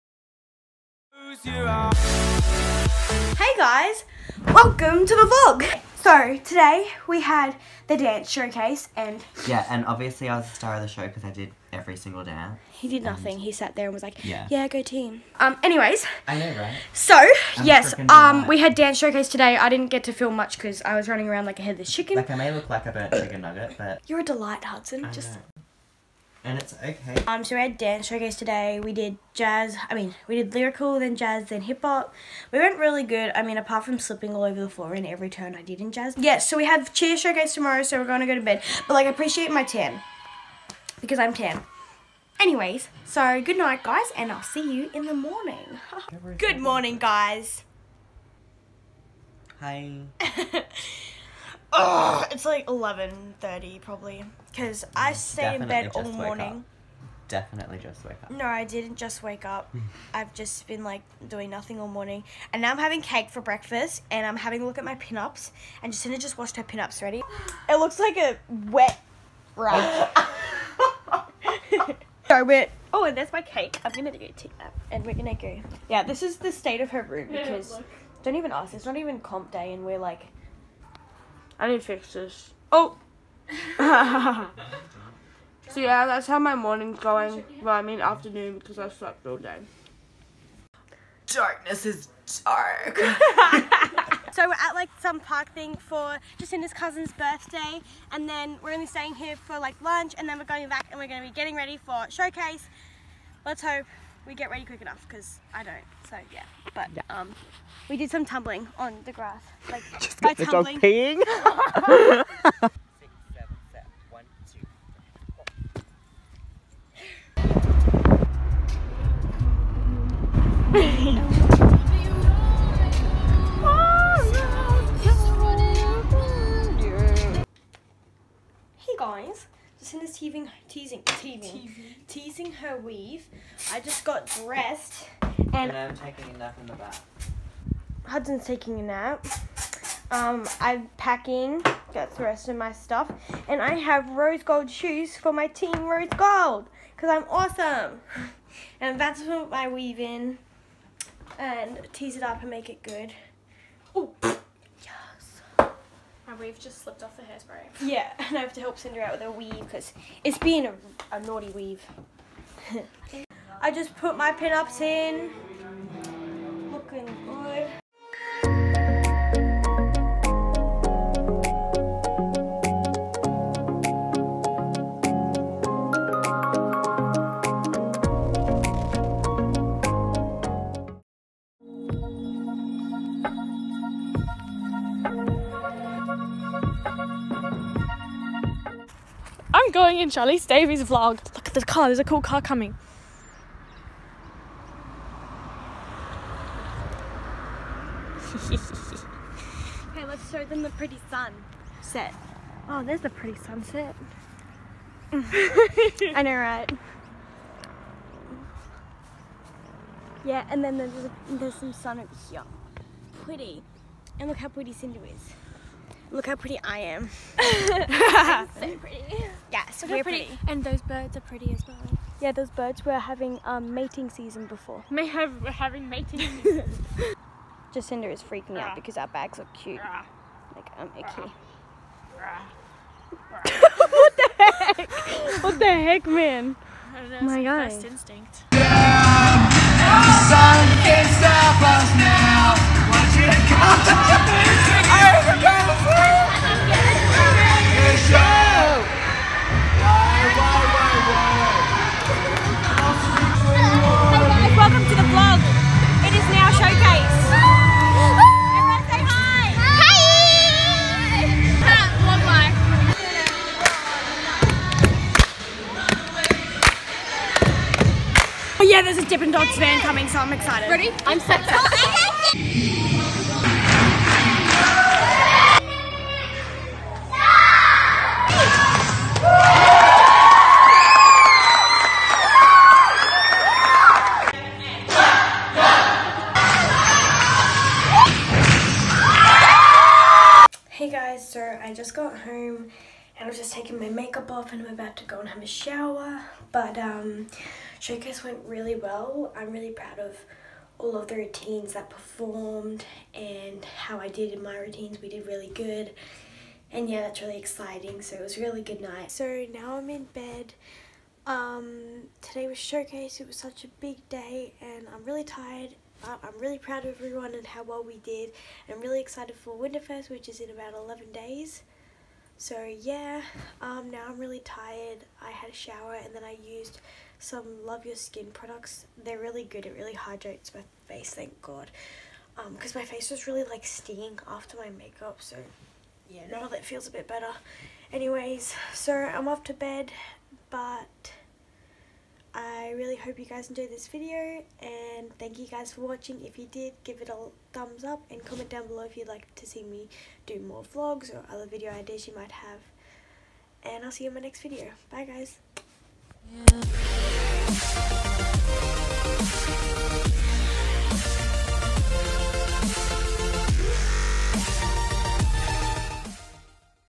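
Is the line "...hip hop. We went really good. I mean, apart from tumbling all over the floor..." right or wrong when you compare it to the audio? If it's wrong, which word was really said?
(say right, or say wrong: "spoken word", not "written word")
wrong: "slipping", not "tumbling".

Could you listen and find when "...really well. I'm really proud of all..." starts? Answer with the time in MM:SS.
04:58.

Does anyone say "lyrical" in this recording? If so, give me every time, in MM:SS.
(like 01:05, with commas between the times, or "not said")
00:30.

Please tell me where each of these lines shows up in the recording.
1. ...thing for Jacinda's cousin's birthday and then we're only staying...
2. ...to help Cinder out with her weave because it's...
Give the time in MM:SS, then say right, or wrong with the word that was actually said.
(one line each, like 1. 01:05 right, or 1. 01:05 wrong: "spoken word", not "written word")
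1. 01:35 right
2. 02:38 right.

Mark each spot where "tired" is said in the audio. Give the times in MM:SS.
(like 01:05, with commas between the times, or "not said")
05:15, 05:24.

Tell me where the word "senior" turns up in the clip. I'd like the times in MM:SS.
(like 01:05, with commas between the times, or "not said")
not said.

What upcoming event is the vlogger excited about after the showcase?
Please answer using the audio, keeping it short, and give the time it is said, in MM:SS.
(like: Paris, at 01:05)
Winterfest, at 05:19.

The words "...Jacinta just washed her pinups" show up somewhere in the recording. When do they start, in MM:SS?
01:05.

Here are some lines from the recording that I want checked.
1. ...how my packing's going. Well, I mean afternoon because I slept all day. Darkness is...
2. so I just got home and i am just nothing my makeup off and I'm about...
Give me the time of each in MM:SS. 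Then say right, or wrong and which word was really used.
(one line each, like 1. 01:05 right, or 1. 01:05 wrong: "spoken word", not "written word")
1. 01:26 wrong: "morning", not "packing"
2. 04:51 wrong: "taking", not "nothing".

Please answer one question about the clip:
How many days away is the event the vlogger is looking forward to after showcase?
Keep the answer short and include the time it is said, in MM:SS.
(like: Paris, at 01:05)
11, at 05:20.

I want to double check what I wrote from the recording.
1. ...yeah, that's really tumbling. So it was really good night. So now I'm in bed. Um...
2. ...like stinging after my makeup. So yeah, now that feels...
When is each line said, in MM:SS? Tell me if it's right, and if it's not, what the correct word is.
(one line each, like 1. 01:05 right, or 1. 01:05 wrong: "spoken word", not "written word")
1. 05:06 wrong: "exciting", not "tumbling"
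2. 05:33 right.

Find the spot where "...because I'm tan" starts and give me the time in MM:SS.
00:40.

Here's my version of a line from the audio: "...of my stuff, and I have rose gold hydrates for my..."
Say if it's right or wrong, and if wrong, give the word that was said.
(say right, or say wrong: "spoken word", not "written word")
wrong: "shoes", not "hydrates".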